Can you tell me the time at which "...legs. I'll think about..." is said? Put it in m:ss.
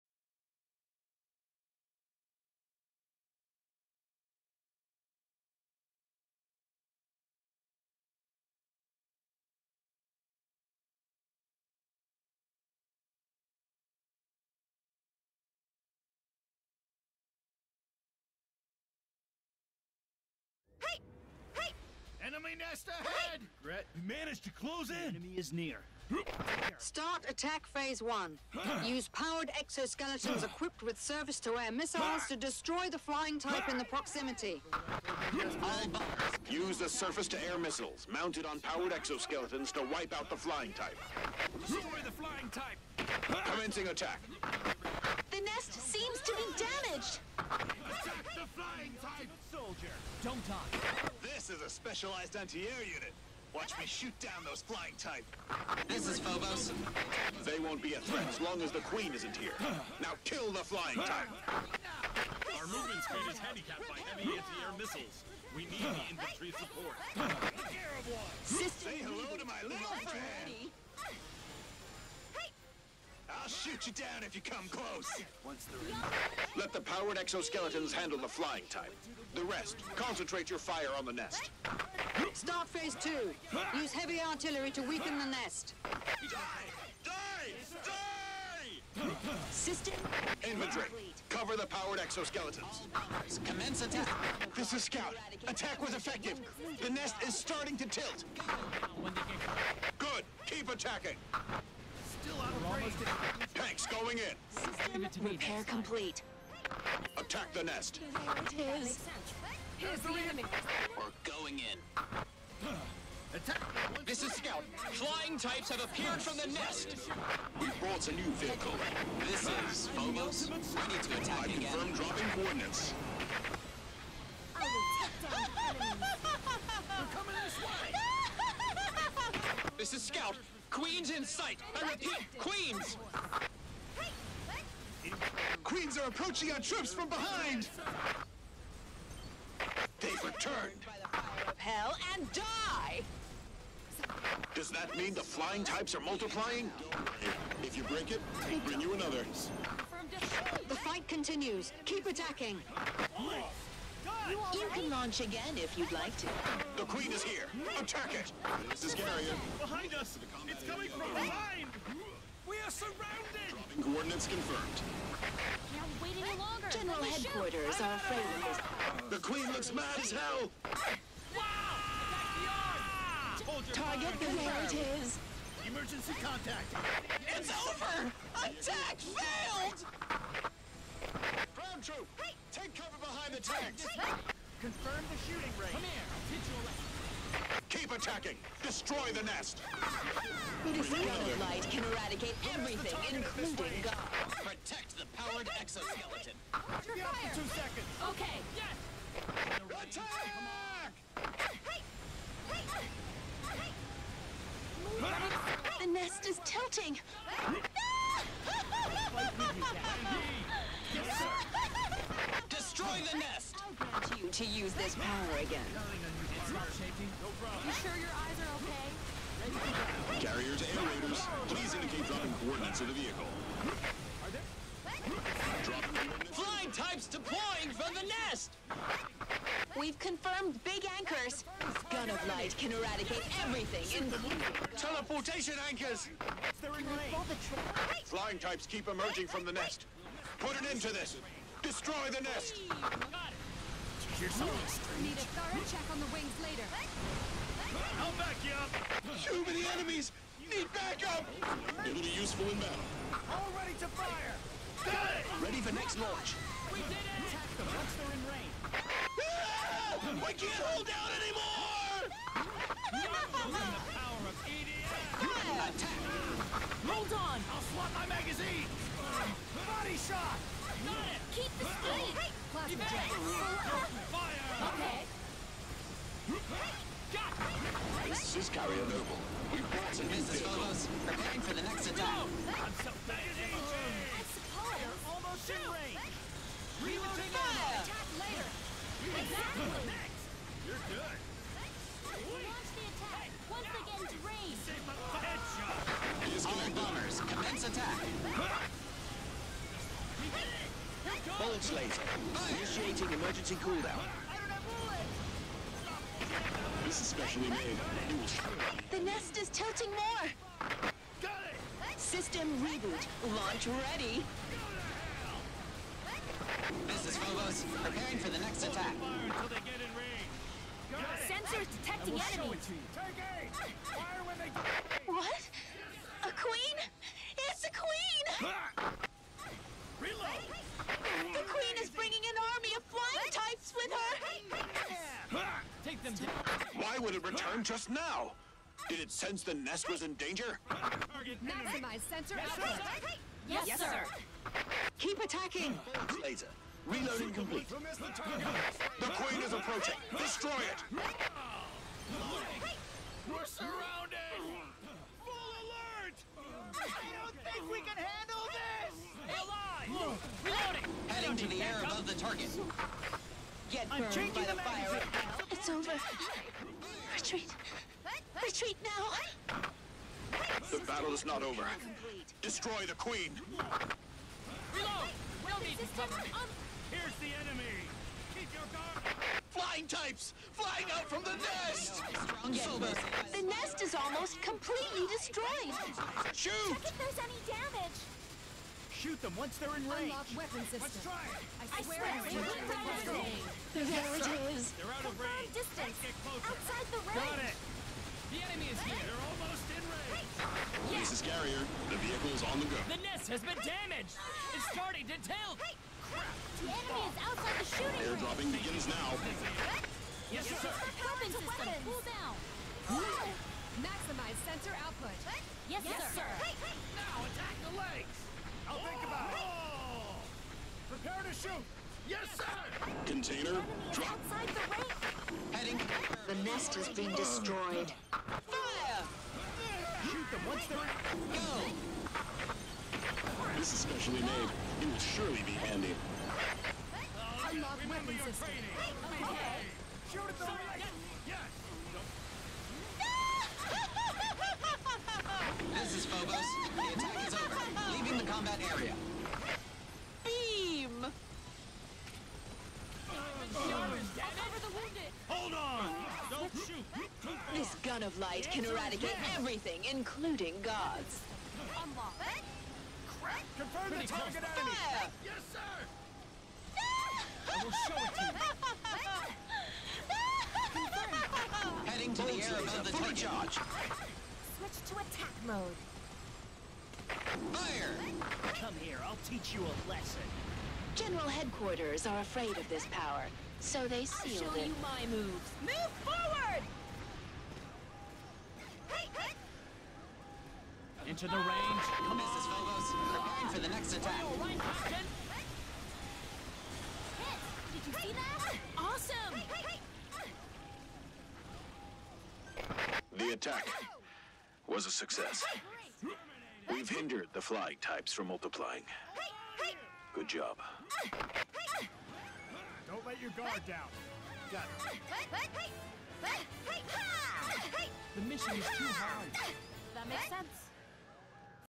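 6:57.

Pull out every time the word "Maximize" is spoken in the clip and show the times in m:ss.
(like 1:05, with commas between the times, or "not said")
5:40, 6:53.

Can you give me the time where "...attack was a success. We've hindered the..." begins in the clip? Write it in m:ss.
8:23.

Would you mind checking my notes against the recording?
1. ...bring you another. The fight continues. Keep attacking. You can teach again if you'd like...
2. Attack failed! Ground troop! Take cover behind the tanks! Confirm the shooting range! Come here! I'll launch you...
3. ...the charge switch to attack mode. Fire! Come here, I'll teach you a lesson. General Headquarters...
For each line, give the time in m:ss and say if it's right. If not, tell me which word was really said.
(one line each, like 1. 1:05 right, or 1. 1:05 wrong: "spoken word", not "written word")
1. 2:28 wrong: "launch", not "teach"
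2. 2:58 wrong: "teach", not "launch"
3. 7:53 right.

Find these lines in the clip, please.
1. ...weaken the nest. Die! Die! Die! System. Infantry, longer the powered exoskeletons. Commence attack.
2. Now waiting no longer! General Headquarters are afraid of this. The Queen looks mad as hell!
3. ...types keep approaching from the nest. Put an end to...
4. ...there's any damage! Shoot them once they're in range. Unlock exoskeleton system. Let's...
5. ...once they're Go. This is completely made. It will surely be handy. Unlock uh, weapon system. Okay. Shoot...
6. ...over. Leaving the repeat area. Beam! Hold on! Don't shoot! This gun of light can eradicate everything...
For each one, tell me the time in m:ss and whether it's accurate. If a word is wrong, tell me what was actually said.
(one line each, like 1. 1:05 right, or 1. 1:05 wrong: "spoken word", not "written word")
1. 1:24 wrong: "cover", not "longer"
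2. 2:45 right
3. 3:58 wrong: "emerging", not "approaching"
4. 6:26 wrong: "weapon", not "exoskeleton"
5. 7:10 wrong: "specially", not "completely"
6. 7:27 wrong: "combat", not "repeat".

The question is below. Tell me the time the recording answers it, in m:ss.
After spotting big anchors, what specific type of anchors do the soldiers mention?
3:54.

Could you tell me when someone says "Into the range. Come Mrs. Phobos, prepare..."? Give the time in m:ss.
8:11.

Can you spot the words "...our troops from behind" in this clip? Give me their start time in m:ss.
2:16.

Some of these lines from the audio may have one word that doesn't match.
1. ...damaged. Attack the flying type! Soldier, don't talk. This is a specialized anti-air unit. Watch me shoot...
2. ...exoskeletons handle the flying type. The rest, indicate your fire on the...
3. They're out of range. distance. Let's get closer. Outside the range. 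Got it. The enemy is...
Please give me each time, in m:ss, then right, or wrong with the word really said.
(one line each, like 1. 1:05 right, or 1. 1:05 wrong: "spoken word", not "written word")
1. 0:46 right
2. 1:17 wrong: "concentrate", not "indicate"
3. 6:34 right.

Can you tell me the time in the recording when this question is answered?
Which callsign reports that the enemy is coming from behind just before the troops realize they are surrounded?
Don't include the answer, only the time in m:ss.
2:38.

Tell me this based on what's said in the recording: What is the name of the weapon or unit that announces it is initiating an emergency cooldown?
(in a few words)
Bolt Slater.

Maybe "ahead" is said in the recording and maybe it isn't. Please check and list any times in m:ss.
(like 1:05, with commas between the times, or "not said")
0:22.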